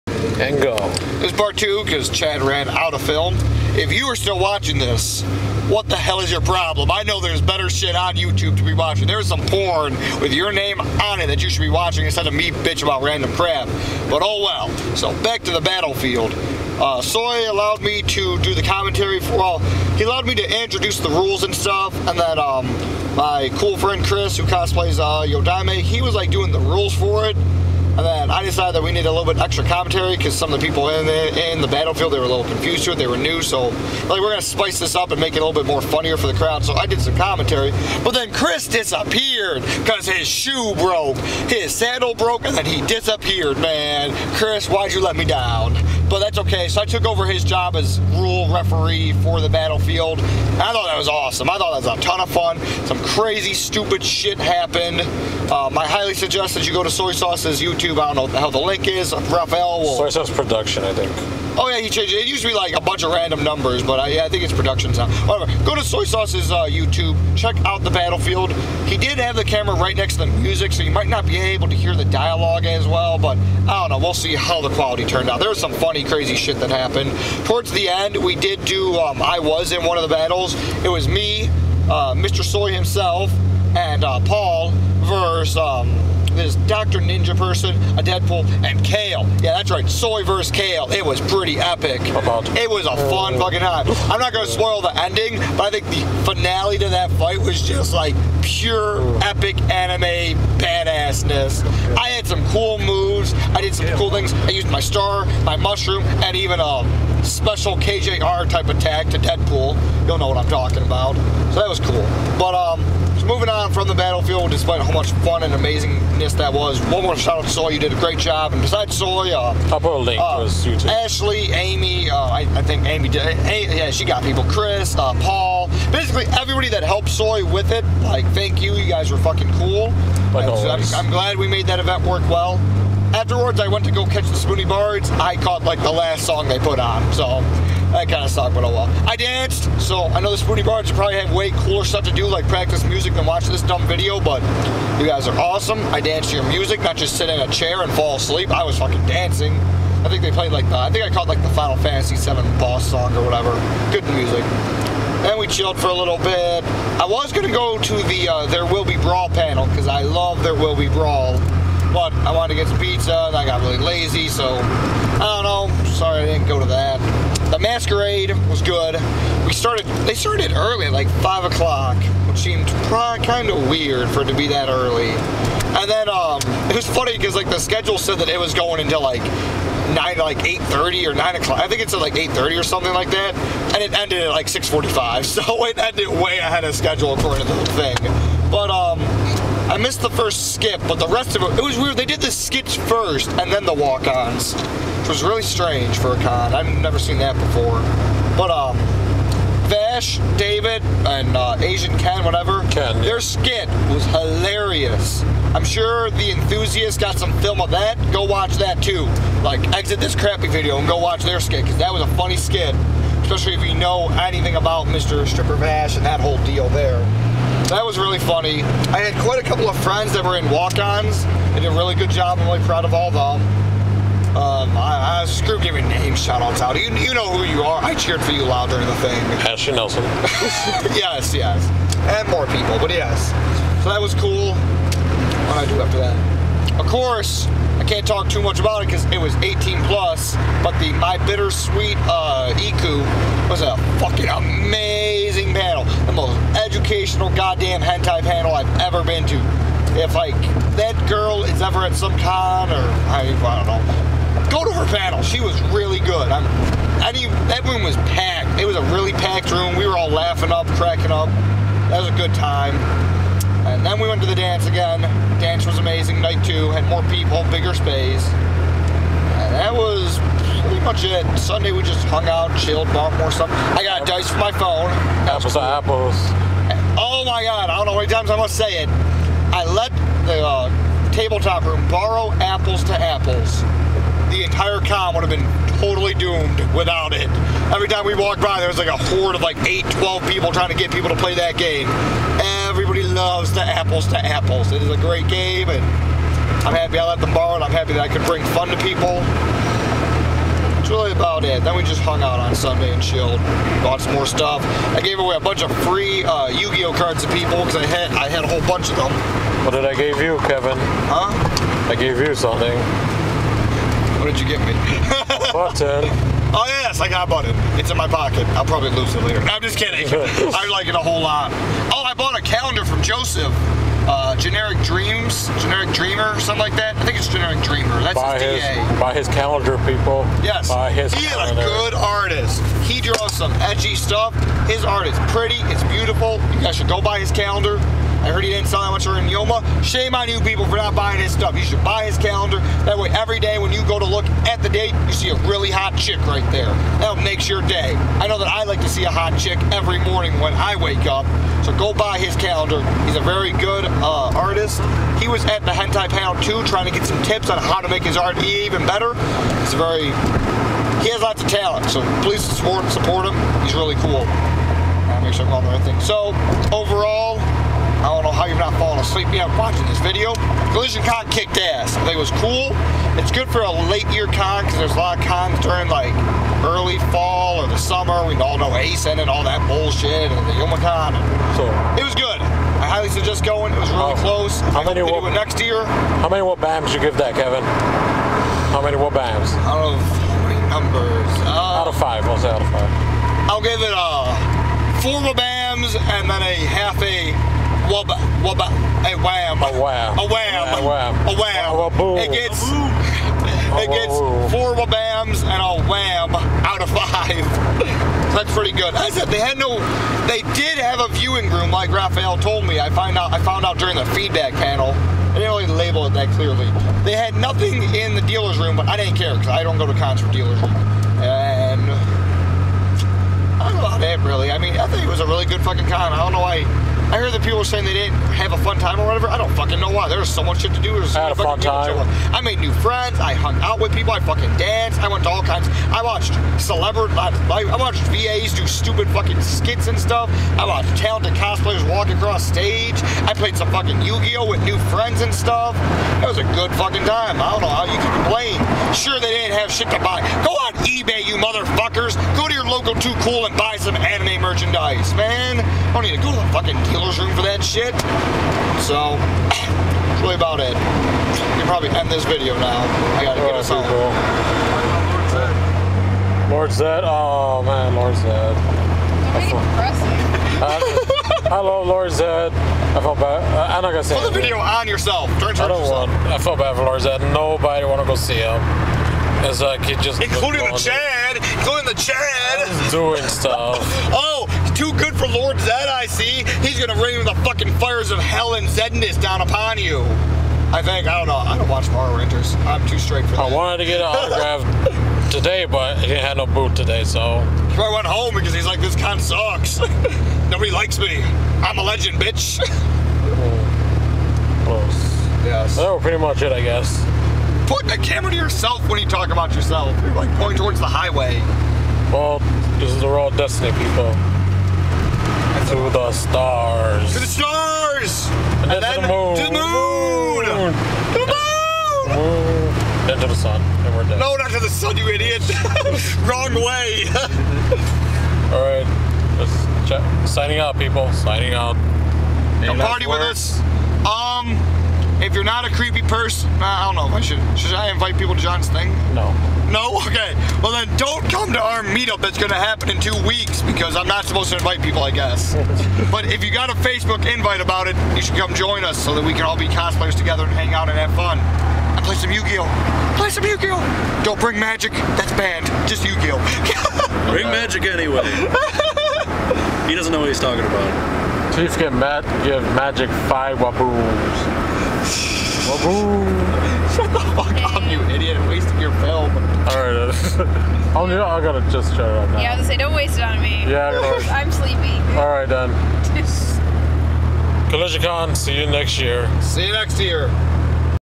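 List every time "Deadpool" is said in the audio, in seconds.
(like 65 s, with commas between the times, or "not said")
88 s, 109 s.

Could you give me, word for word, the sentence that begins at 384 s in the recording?
How I many what, do it next year?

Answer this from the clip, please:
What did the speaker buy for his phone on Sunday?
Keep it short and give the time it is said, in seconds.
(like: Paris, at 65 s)
Dice, at 274 s.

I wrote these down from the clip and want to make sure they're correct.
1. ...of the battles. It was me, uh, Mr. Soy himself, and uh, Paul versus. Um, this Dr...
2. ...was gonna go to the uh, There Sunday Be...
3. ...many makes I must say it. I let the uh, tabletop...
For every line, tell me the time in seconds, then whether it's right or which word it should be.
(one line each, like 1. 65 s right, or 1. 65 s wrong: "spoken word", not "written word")
1. 79 s right
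2. 157 s wrong: "Will", not "Sunday"
3. 277 s wrong: "times", not "makes".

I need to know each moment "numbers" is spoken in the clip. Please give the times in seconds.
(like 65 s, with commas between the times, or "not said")
63 s, 390 s.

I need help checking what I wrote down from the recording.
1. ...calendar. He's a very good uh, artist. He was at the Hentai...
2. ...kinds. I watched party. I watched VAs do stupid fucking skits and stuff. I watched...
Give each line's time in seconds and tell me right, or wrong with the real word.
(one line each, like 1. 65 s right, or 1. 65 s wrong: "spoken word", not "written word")
1. 352 s right
2. 435 s wrong: "celebrity", not "party".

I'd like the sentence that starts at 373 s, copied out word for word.
It's good for a late year con because there's a lot of cons during like early fall or the summer.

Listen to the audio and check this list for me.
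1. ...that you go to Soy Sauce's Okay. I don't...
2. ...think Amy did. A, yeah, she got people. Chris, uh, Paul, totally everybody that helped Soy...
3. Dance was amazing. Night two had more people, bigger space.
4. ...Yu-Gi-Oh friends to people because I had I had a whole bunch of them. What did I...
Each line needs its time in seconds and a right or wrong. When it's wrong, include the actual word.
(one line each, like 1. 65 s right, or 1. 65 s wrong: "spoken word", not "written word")
1. 56 s wrong: "YouTube", not "Okay"
2. 122 s wrong: "basically", not "totally"
3. 265 s right
4. 306 s wrong: "cards", not "friends".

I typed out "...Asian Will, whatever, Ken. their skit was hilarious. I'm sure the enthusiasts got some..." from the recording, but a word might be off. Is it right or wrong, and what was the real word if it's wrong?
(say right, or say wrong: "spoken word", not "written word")
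wrong: "Ken", not "Will".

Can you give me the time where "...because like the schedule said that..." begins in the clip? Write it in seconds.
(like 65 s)
177 s.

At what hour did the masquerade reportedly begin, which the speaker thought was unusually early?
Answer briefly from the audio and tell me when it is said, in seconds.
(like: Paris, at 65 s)
5 o'clock, at 171 s.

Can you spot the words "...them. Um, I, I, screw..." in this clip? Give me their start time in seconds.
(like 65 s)
223 s.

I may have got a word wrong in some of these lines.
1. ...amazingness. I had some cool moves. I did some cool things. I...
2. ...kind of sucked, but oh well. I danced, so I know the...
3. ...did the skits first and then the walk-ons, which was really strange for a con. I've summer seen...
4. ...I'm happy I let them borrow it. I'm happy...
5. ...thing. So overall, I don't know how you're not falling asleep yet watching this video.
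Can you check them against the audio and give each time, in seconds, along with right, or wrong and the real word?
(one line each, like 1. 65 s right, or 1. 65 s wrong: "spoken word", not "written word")
1. 100 s wrong: "badassness", not "amazingness"
2. 138 s right
3. 192 s wrong: "never", not "summer"
4. 296 s right
5. 365 s right.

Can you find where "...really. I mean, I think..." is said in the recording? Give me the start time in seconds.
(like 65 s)
424 s.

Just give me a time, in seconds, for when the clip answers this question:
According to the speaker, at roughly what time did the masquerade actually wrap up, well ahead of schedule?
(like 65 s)
184 s.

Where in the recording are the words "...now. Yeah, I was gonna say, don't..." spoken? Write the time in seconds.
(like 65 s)
572 s.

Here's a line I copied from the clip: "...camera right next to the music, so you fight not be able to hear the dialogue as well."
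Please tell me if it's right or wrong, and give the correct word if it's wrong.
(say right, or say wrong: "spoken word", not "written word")
wrong: "might", not "fight".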